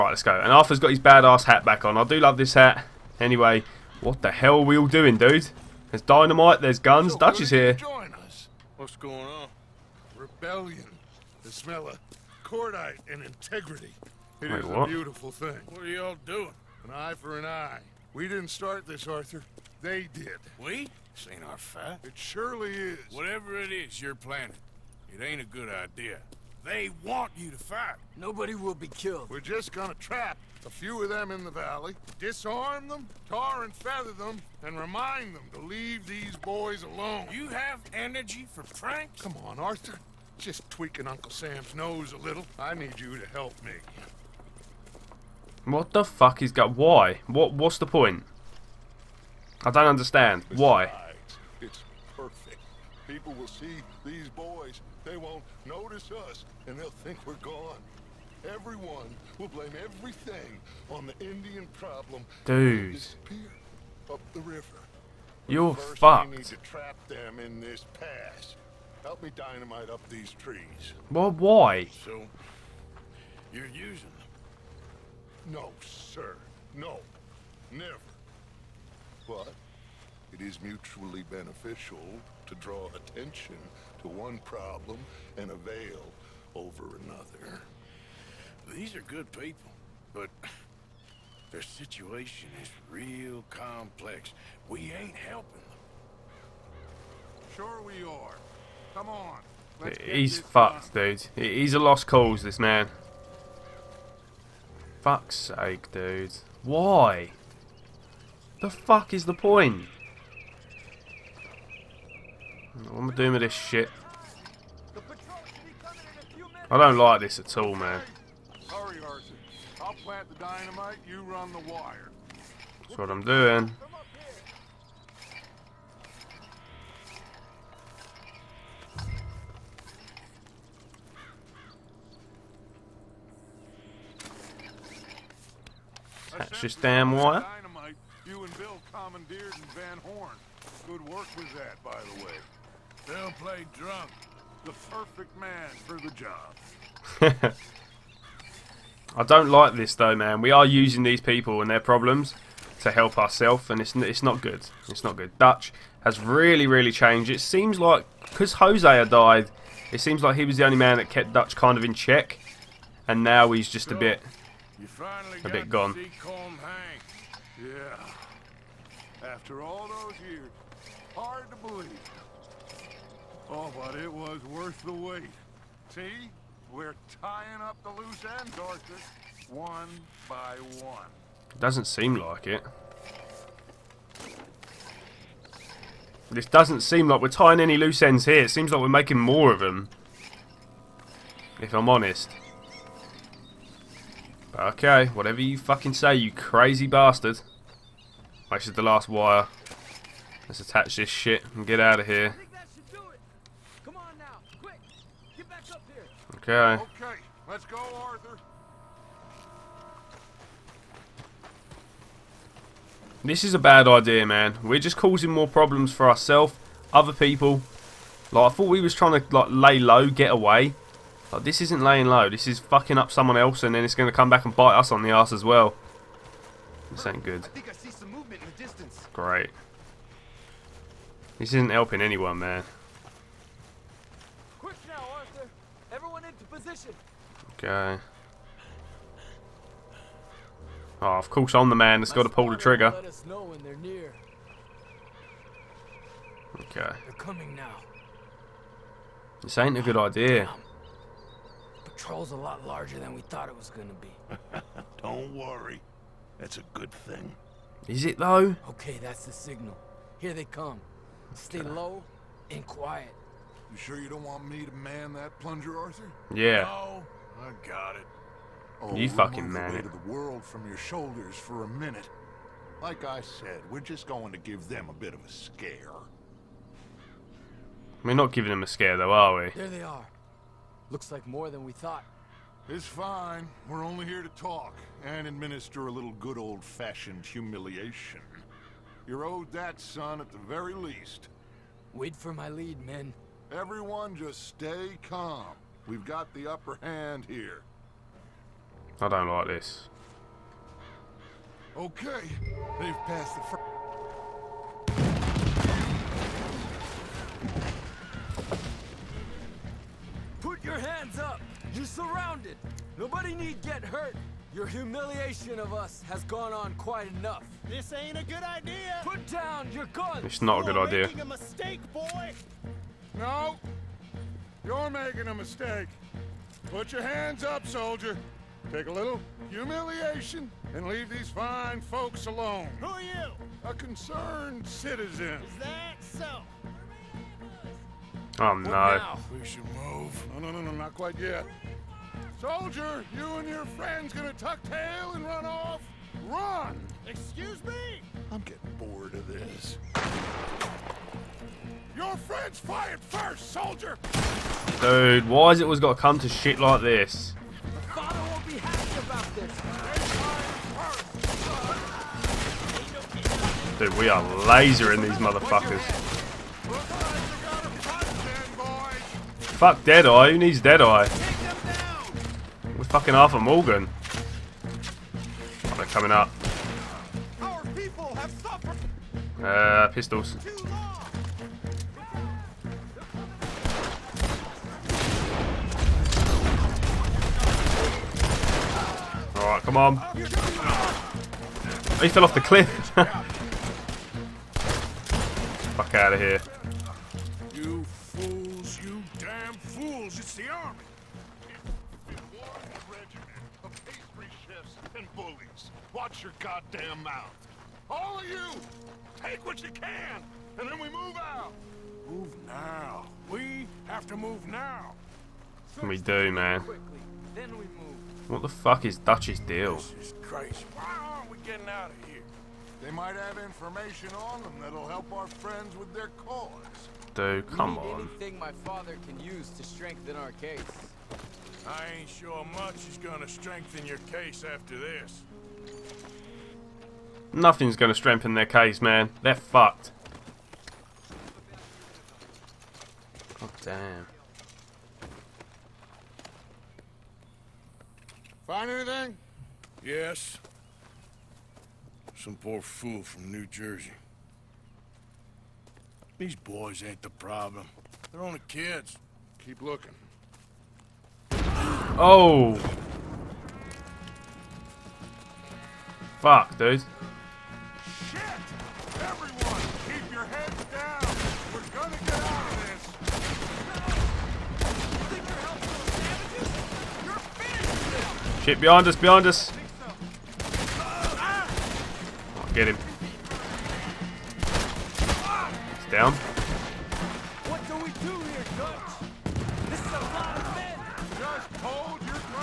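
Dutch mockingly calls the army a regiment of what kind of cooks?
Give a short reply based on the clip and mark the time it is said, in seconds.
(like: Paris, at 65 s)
pastry chefs, at 403 s.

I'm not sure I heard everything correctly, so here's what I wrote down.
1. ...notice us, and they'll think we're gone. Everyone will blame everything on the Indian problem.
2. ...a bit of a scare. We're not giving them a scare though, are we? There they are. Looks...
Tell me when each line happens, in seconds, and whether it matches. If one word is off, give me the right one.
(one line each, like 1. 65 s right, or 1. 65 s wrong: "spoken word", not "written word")
1. 55 s right
2. 274 s right.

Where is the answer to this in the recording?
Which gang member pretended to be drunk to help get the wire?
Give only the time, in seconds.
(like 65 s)
143 s.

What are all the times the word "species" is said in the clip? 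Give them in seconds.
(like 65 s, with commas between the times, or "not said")
not said.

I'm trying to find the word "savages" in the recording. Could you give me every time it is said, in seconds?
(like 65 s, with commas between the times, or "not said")
477 s.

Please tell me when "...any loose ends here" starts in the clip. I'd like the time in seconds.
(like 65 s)
187 s.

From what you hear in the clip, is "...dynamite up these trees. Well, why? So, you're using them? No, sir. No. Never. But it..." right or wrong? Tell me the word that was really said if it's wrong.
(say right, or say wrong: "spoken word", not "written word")
right.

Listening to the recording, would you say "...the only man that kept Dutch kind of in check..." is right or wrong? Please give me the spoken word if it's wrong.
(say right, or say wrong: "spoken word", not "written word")
right.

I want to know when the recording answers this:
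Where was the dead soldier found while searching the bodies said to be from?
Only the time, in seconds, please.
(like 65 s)
453 s.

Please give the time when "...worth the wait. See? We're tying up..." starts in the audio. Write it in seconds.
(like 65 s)
174 s.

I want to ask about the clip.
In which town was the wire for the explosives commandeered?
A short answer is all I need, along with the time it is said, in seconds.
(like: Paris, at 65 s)
Van Horn, at 139 s.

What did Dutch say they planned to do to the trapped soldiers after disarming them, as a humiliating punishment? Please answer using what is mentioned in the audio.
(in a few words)
tar and feather them.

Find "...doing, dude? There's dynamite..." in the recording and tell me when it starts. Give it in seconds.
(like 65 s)
4 s.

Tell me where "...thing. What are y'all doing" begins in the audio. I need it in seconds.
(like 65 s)
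15 s.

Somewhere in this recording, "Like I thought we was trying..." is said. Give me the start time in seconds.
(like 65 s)
218 s.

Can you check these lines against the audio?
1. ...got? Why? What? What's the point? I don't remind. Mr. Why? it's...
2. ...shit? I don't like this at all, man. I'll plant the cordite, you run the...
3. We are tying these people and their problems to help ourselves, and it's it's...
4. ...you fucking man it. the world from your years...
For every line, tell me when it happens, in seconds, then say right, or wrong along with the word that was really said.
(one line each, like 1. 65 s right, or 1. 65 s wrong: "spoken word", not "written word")
1. 46 s wrong: "understand", not "remind"
2. 113 s wrong: "dynamite", not "cordite"
3. 150 s wrong: "using", not "tying"
4. 268 s wrong: "shoulders", not "years".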